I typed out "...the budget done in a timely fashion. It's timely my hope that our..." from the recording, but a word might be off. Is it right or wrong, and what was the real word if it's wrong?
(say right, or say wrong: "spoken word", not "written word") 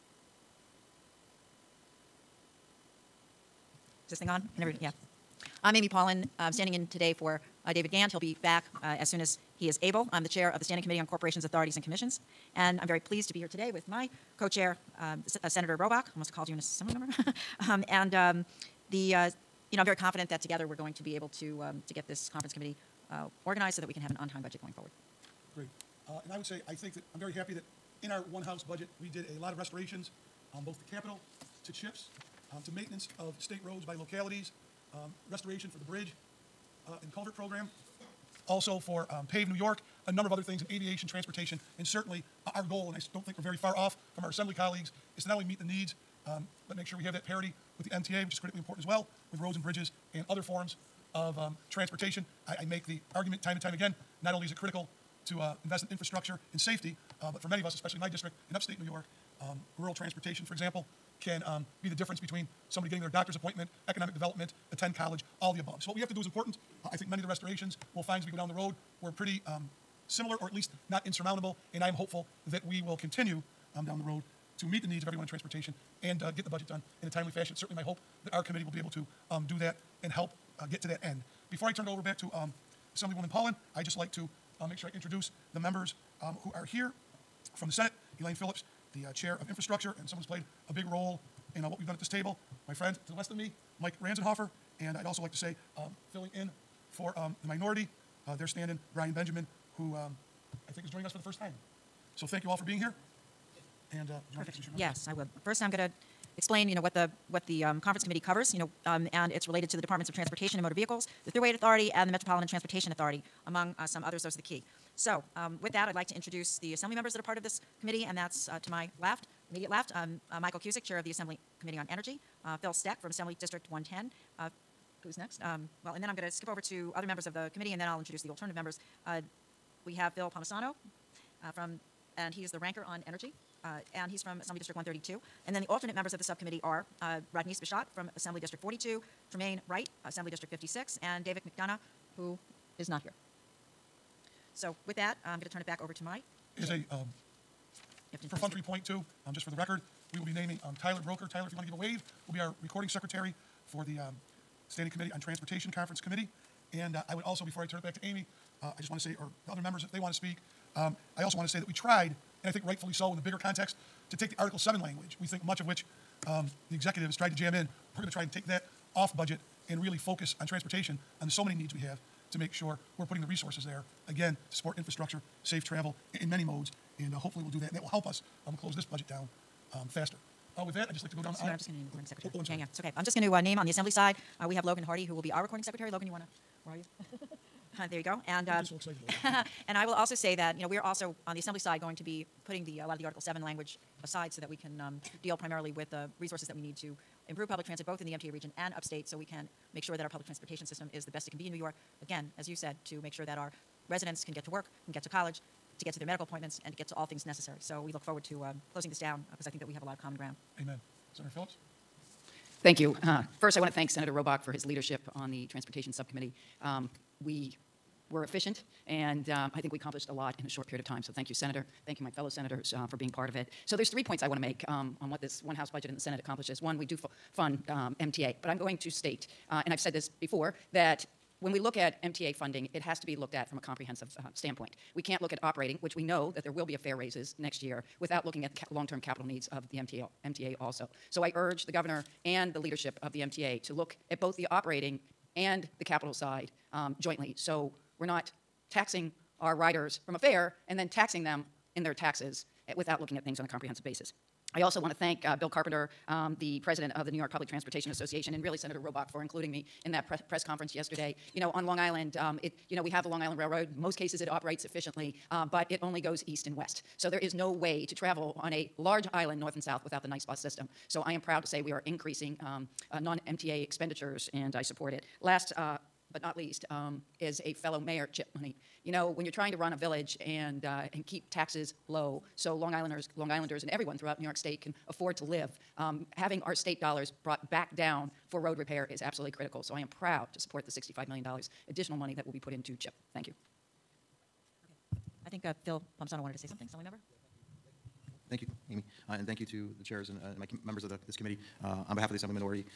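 wrong: "certainly", not "timely".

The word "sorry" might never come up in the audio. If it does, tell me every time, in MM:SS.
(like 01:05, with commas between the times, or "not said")
03:02.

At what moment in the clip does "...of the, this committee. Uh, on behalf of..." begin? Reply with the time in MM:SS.
05:00.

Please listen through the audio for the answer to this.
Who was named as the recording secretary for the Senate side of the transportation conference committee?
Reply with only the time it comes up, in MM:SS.
02:30.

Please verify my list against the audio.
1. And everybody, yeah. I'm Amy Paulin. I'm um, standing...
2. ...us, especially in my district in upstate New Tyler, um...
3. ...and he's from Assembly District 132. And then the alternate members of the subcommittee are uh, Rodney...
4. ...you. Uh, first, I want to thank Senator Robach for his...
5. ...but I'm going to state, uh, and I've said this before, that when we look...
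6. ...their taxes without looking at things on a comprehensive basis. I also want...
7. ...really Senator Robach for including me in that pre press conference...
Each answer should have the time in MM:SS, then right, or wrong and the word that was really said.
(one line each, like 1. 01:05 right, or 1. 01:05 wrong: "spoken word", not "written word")
1. 00:04 right
2. 00:57 wrong: "York", not "Tyler"
3. 02:13 right
4. 03:32 right
5. 03:48 right
6. 04:11 right
7. 04:18 right.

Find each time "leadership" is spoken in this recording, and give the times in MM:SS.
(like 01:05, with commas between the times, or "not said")
03:34, 04:02.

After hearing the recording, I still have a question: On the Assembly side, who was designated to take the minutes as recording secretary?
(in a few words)
Logan Hardy.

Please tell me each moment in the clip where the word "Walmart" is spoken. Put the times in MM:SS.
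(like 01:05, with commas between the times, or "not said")
not said.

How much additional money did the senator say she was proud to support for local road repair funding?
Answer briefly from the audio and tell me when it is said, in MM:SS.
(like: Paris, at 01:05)
$65 million, at 04:50.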